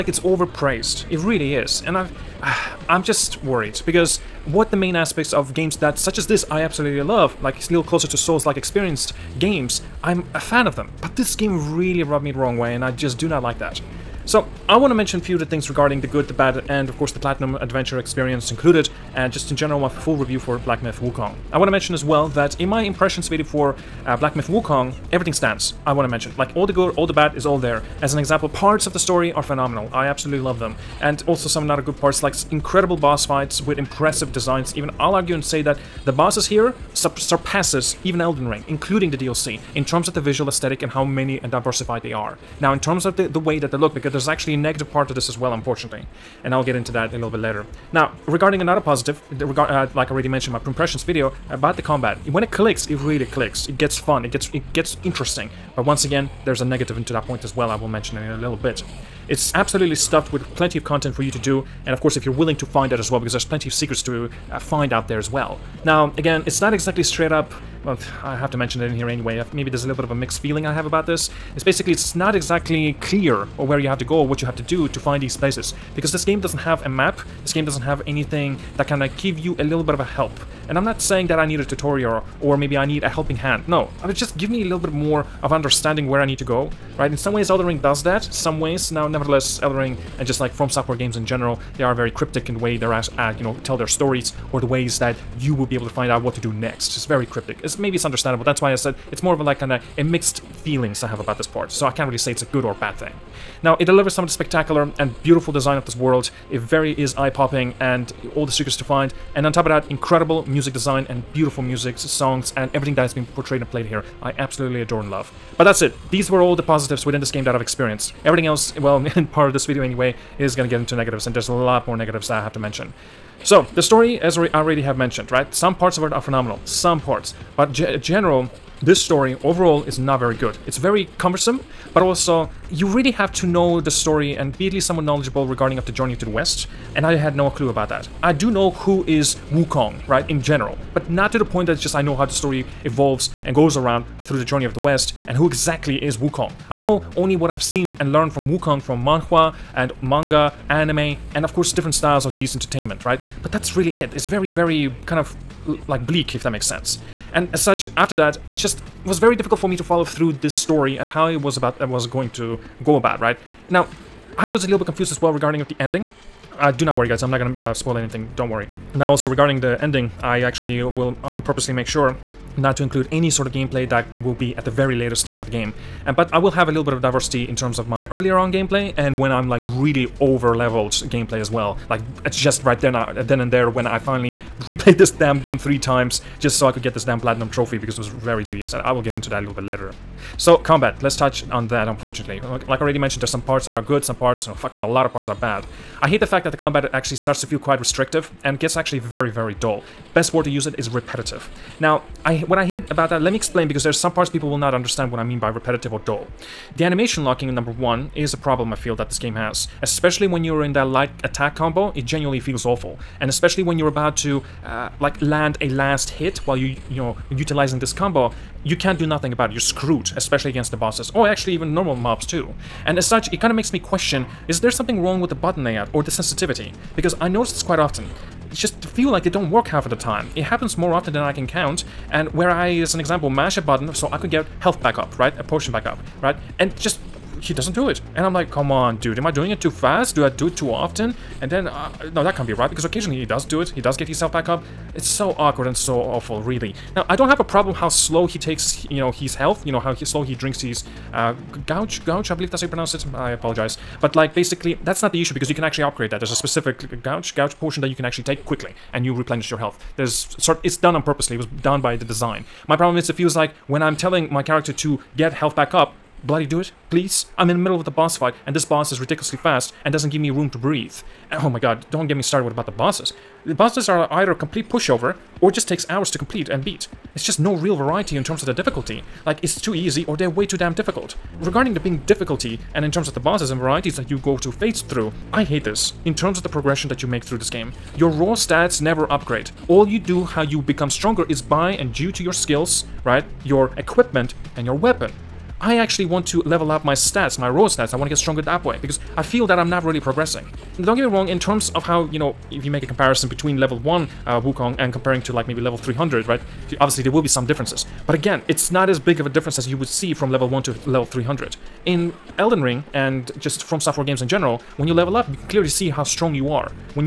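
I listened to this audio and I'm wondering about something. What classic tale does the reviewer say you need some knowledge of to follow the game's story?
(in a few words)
Journey to the West.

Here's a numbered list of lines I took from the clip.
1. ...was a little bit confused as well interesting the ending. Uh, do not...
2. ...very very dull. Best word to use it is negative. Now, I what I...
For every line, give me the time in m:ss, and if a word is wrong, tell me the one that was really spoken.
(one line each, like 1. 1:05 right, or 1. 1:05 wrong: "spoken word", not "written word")
1. 2:44 wrong: "regarding", not "interesting"
2. 3:18 wrong: "repetitive", not "negative".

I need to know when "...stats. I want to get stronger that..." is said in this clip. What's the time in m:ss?
4:57.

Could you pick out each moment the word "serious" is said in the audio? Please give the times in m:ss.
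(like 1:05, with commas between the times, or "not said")
not said.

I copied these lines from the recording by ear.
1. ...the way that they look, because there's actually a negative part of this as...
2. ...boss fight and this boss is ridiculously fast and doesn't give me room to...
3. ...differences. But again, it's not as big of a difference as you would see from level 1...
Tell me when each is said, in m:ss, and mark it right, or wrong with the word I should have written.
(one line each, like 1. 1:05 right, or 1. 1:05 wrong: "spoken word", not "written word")
1. 0:43 right
2. 4:27 right
3. 5:07 right.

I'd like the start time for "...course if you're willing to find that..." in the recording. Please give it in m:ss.
1:01.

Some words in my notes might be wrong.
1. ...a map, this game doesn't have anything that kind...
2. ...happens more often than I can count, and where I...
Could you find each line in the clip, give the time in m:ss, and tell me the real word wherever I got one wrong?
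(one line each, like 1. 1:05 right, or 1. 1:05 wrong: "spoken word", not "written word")
1. 1:16 right
2. 3:50 right.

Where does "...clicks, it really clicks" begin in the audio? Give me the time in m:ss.
0:52.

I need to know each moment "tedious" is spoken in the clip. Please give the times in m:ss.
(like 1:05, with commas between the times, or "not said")
3:08.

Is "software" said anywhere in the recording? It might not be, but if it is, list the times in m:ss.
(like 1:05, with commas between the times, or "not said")
1:30, 5:13.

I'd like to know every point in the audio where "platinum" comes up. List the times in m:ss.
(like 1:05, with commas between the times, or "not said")
0:17, 3:07.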